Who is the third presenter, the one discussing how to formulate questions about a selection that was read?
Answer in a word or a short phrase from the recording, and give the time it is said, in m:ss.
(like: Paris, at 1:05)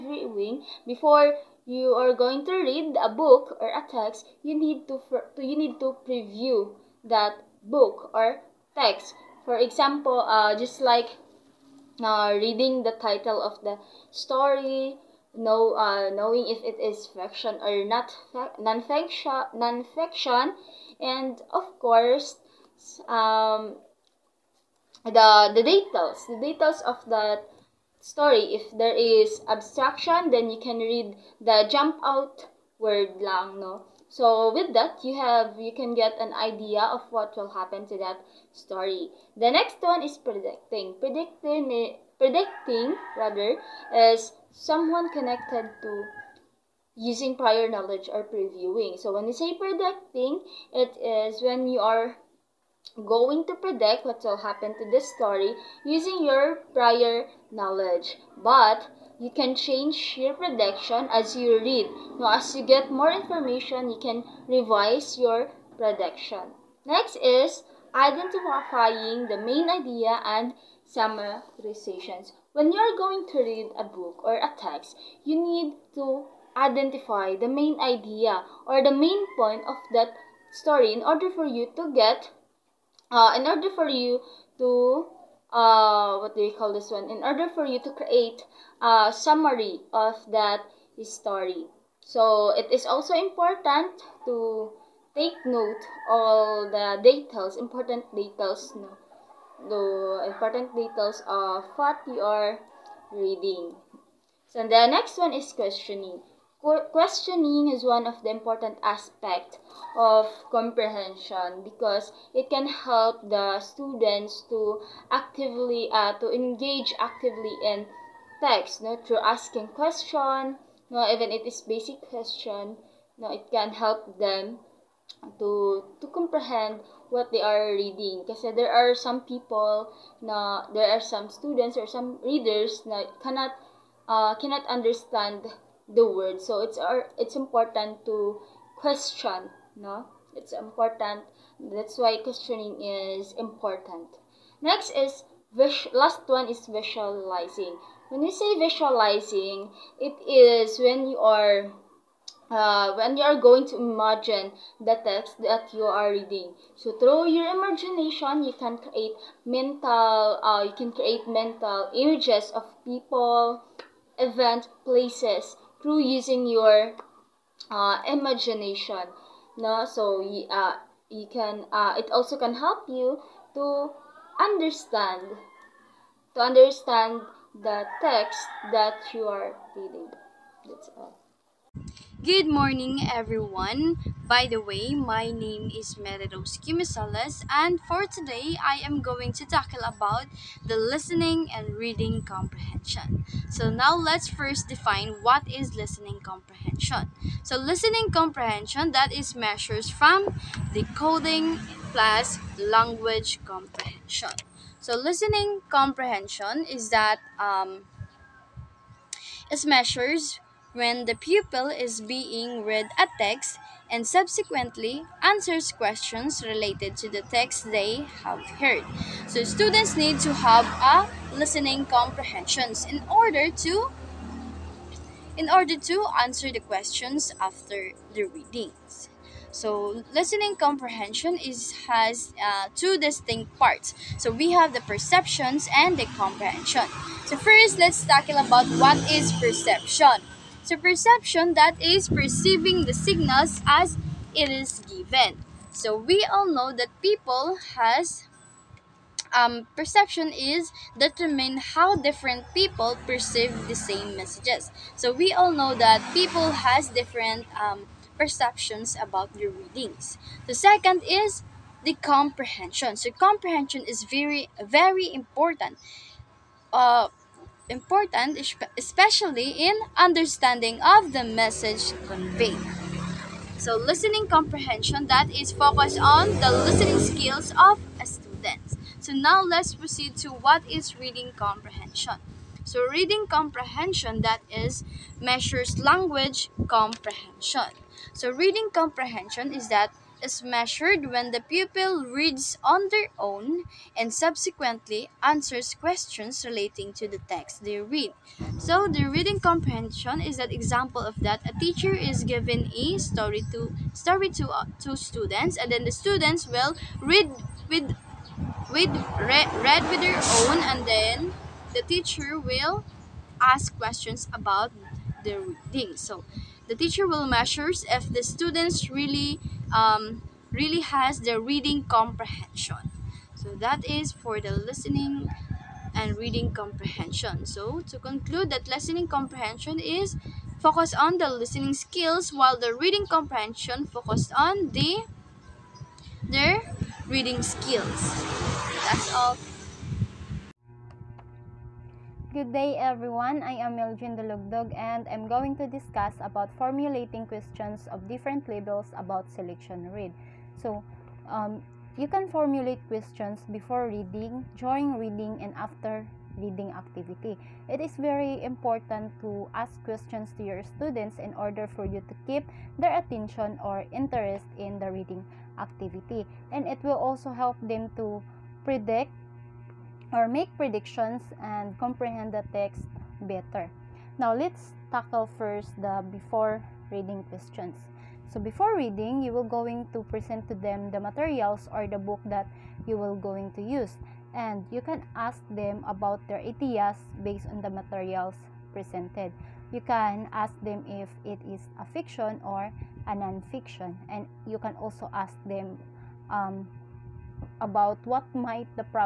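Meljin Dalugdog, at 5:43.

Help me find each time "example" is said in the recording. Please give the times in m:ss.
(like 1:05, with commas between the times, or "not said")
0:09, 5:00.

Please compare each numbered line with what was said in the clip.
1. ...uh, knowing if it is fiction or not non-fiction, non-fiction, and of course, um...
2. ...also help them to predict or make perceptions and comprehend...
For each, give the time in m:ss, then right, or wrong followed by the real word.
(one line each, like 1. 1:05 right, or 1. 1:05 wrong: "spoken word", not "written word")
1. 0:15 right
2. 6:07 wrong: "predictions", not "perceptions".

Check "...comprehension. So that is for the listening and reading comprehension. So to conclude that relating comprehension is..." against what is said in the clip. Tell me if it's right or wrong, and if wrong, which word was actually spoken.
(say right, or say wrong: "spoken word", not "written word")
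wrong: "listening", not "relating".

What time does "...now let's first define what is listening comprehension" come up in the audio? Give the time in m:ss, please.
3:13.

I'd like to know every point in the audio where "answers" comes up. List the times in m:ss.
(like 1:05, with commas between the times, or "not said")
3:35, 3:46, 4:55.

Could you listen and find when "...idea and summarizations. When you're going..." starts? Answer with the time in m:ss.
1:09.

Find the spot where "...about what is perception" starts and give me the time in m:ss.
3:58.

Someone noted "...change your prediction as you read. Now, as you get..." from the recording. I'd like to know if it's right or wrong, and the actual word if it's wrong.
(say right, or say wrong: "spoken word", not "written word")
right.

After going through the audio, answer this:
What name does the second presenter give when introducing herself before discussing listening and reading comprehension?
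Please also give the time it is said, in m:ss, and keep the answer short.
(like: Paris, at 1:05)
Meridos Kimisales, at 3:06.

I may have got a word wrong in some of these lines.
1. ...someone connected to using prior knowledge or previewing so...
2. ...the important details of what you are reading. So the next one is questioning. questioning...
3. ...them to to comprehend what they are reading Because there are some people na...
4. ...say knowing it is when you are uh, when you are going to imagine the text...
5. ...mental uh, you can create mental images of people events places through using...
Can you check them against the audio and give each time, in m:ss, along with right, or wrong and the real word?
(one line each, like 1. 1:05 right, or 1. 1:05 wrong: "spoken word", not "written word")
1. 0:44 right
2. 1:39 right
3. 2:04 right
4. 2:28 wrong: "visualizing", not "knowing"
5. 2:39 right.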